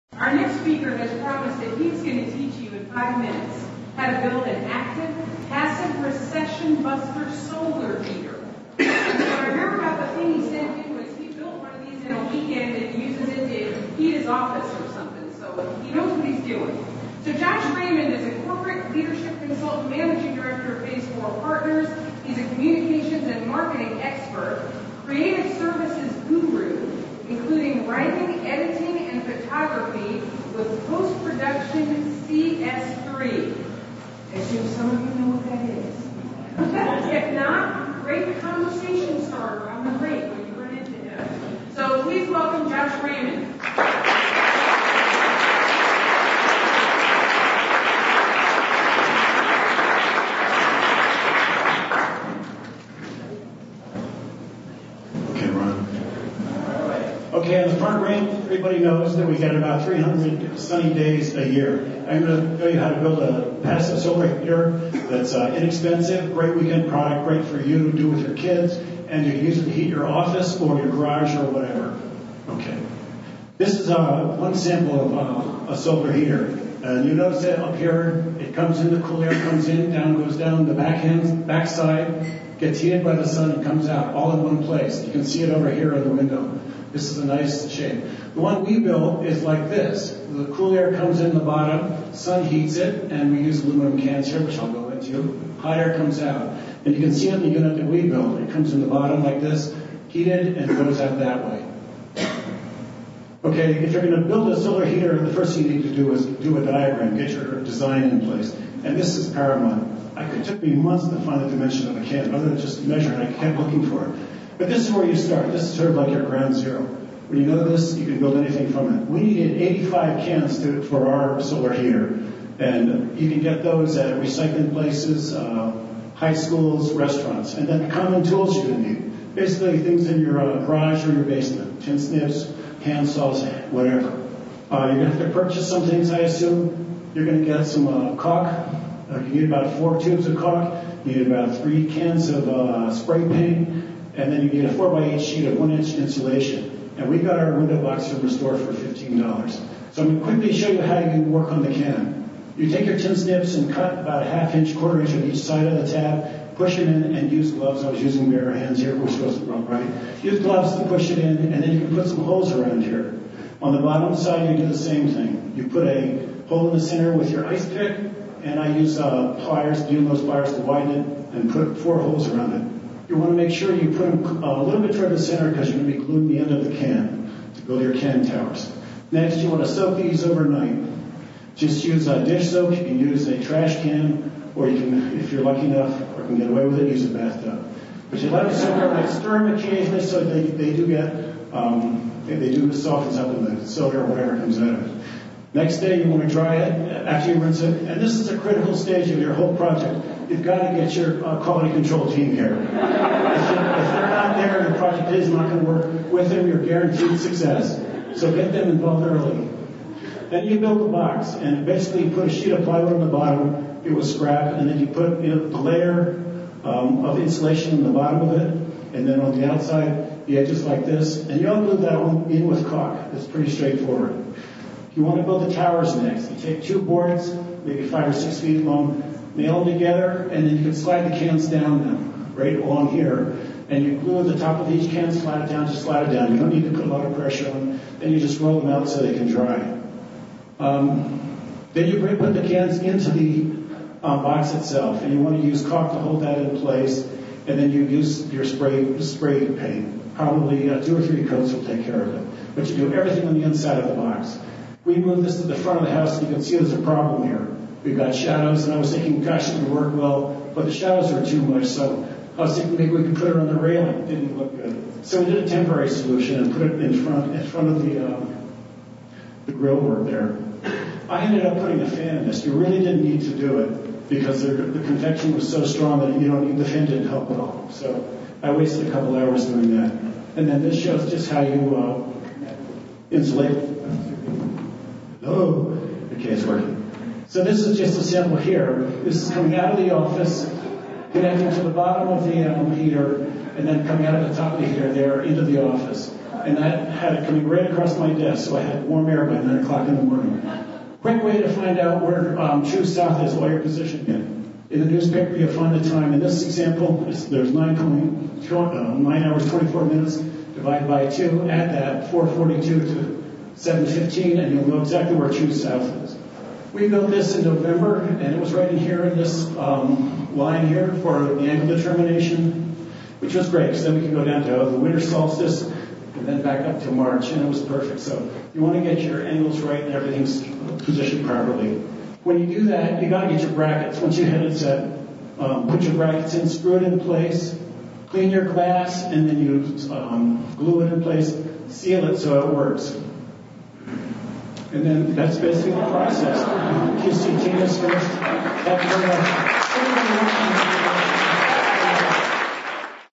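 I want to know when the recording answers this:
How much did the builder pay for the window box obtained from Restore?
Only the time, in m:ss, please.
2:28.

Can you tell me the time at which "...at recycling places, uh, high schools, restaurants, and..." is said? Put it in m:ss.
2:03.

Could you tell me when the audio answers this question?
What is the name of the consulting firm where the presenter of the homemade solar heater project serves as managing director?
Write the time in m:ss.
0:20.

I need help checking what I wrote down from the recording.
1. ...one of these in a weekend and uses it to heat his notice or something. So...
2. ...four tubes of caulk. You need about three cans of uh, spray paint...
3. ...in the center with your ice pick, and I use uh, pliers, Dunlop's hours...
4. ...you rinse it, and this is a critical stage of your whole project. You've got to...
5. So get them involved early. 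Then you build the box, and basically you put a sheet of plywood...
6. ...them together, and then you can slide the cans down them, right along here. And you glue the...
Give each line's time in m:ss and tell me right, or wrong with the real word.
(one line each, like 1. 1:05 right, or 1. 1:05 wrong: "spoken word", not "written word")
1. 0:11 wrong: "office", not "notice"
2. 2:19 right
3. 2:46 wrong: "pliers", not "hours"
4. 3:17 right
5. 3:28 right
6. 3:49 right.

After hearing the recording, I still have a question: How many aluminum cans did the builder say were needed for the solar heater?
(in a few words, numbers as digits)
85.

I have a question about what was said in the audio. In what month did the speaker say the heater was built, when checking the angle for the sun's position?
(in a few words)
November.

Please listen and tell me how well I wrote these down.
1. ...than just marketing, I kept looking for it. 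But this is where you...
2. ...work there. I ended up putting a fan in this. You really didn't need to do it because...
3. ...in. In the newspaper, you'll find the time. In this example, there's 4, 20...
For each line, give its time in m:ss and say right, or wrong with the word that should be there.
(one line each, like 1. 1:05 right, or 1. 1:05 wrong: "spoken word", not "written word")
1. 1:52 wrong: "measuring", not "marketing"
2. 4:29 right
3. 5:04 wrong: "9", not "4".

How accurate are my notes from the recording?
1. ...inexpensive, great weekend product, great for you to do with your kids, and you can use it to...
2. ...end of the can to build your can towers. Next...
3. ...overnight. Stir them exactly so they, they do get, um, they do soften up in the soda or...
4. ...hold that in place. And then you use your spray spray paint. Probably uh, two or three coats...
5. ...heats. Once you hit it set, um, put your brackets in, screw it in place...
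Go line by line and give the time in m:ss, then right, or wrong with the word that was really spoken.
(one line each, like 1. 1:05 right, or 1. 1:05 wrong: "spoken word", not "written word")
1. 1:05 right
2. 2:56 right
3. 3:08 wrong: "occasionally", not "exactly"
4. 4:05 right
5. 5:33 wrong: "brackets", not "heats".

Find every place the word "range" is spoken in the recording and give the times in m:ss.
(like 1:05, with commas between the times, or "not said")
0:58.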